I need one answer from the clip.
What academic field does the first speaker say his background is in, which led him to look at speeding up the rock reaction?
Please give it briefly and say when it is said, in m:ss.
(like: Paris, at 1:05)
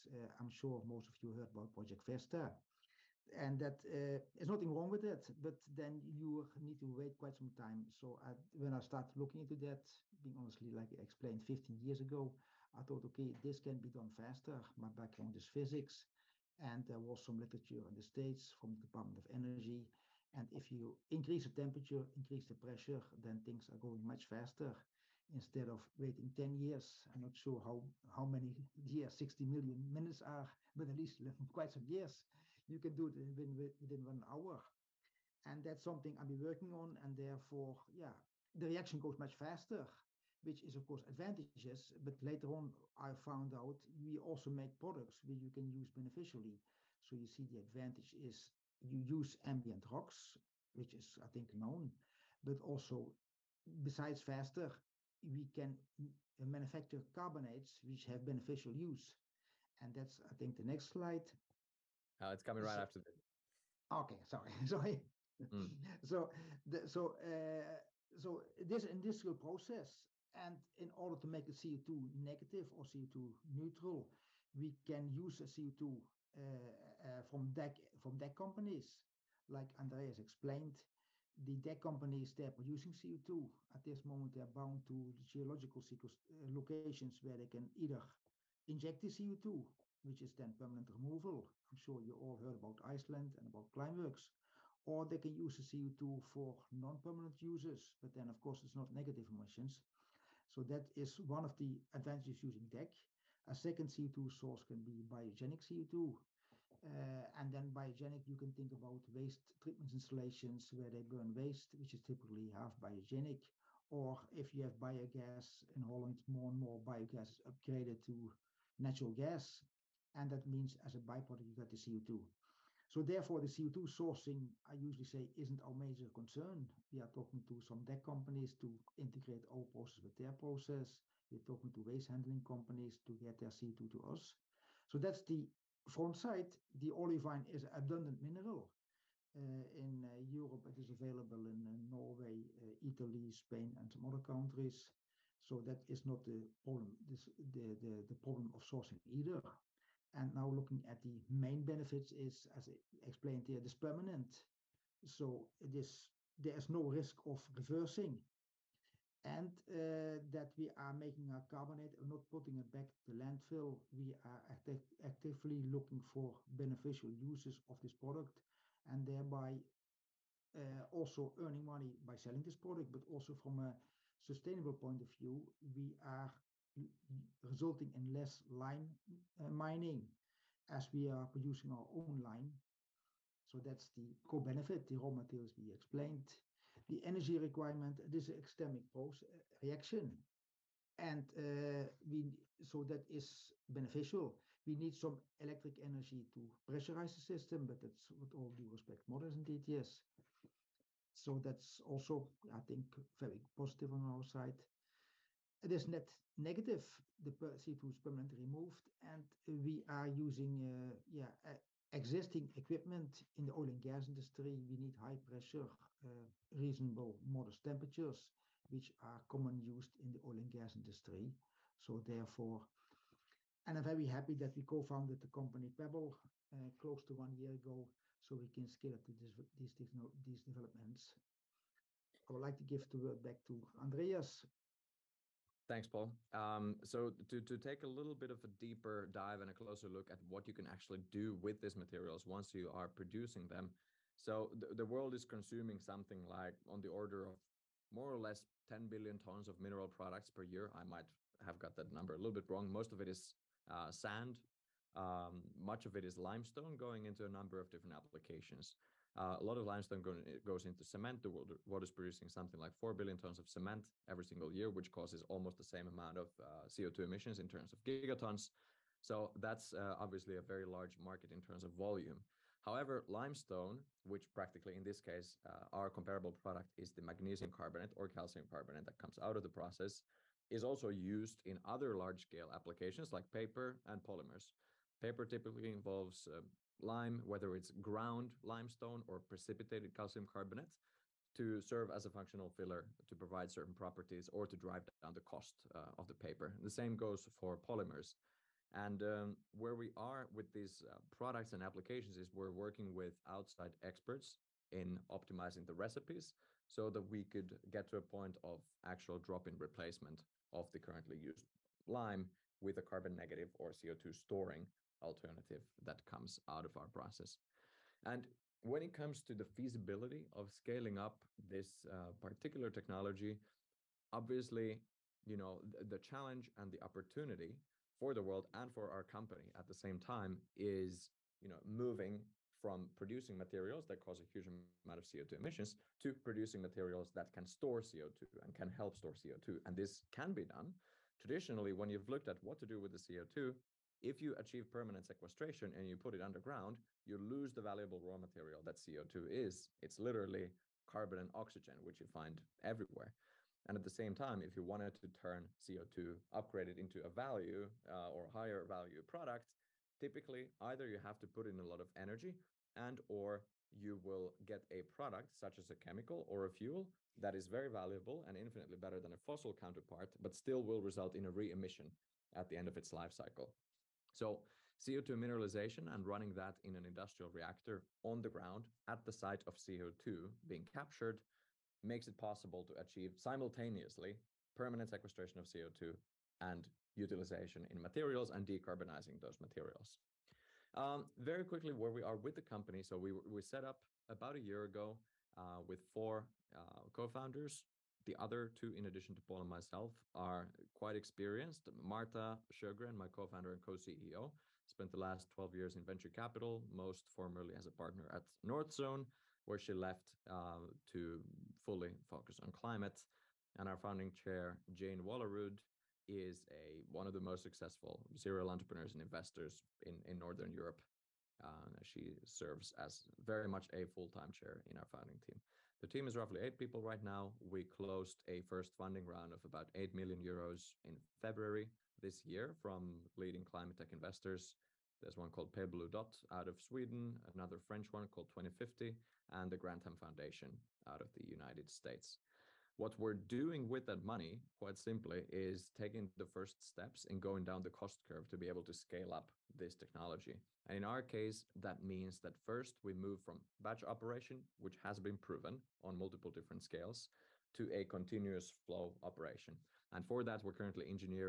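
Physics, at 0:15.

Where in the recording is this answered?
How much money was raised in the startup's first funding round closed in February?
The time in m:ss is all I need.
7:09.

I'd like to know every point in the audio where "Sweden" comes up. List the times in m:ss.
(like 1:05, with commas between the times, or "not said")
7:16.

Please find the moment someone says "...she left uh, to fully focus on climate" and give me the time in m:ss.
6:49.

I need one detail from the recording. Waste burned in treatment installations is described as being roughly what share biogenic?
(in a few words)
Half.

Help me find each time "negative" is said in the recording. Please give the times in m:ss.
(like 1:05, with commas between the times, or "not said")
1:12, 1:38, 3:26, 5:13.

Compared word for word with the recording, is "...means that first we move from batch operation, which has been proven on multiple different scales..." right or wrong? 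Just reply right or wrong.
right.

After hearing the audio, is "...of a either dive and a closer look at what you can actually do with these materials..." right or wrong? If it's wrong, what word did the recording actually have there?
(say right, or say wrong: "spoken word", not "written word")
wrong: "deeper", not "either".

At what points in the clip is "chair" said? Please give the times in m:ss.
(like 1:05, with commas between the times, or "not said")
6:54, 7:04.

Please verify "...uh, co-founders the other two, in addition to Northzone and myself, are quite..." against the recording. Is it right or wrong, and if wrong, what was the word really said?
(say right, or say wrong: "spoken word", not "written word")
wrong: "Pol", not "Northzone".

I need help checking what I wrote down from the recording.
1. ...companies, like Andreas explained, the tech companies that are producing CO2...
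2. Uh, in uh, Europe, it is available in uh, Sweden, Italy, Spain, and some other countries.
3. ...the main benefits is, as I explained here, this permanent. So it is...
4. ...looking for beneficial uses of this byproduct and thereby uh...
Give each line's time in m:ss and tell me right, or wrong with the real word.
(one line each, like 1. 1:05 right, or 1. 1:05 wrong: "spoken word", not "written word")
1. 1:18 right
2. 2:19 wrong: "Norway", not "Sweden"
3. 2:31 right
4. 2:45 wrong: "product", not "byproduct".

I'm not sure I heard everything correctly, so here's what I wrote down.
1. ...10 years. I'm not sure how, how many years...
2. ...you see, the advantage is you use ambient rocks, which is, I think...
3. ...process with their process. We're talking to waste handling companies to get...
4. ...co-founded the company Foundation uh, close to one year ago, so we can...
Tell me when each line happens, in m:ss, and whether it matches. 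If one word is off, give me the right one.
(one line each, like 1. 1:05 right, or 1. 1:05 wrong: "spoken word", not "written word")
1. 0:26 right
2. 0:47 right
3. 2:09 right
4. 3:44 wrong: "Paebbl", not "Foundation".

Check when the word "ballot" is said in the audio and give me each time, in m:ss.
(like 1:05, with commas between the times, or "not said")
not said.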